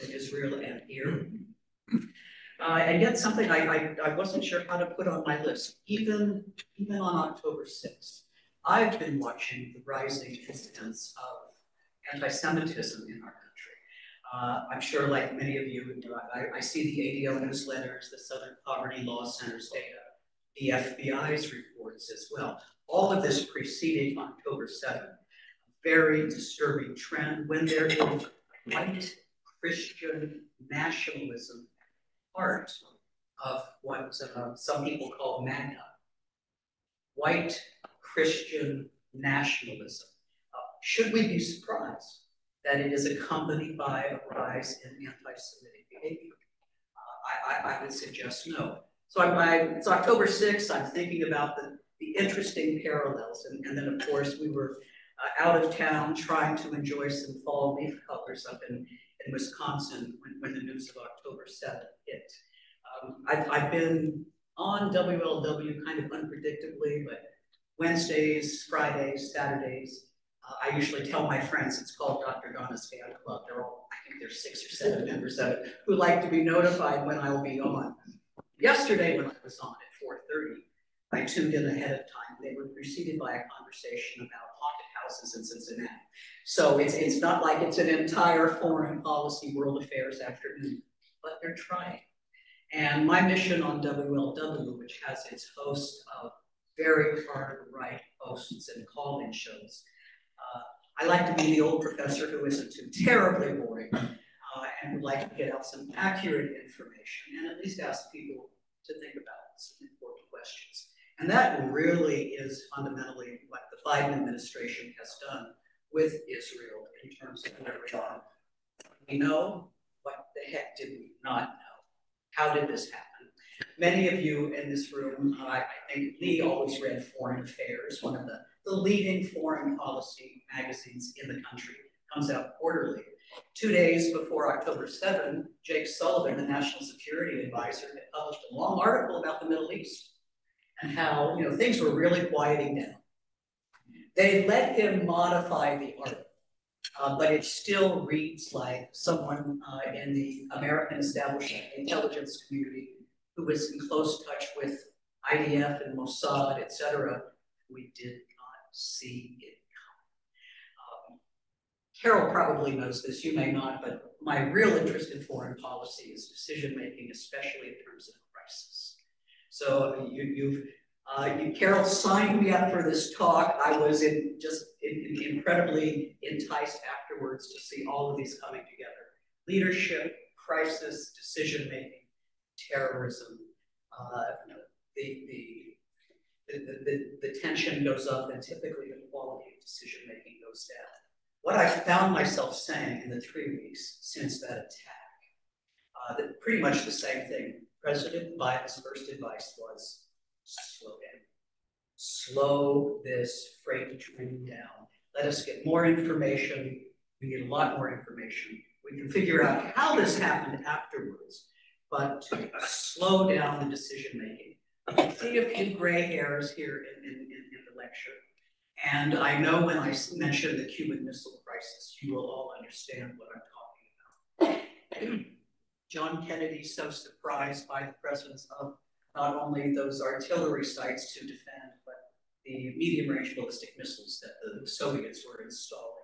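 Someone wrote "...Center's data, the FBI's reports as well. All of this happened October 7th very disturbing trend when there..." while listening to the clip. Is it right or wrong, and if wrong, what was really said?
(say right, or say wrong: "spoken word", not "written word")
wrong: "preceded", not "happened".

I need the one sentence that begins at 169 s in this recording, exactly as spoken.
So you, have uh, Carol signed me up for this talk.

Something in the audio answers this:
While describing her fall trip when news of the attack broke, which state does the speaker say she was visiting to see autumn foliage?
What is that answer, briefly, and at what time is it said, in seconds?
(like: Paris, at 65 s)
Wisconsin, at 59 s.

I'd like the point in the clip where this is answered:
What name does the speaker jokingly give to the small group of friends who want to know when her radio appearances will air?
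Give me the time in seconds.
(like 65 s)
72 s.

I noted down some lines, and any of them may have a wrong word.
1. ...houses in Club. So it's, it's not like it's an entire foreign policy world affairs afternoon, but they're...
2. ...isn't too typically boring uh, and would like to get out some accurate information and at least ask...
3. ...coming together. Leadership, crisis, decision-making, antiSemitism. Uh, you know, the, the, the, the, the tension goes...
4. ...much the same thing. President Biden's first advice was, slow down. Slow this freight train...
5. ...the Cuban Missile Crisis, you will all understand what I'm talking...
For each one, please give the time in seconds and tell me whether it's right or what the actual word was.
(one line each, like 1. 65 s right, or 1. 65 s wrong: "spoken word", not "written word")
1. 85 s wrong: "Cincinnati", not "Club"
2. 102 s wrong: "terribly", not "typically"
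3. 178 s wrong: "terrorism", not "antiSemitism"
4. 196 s right
5. 220 s right.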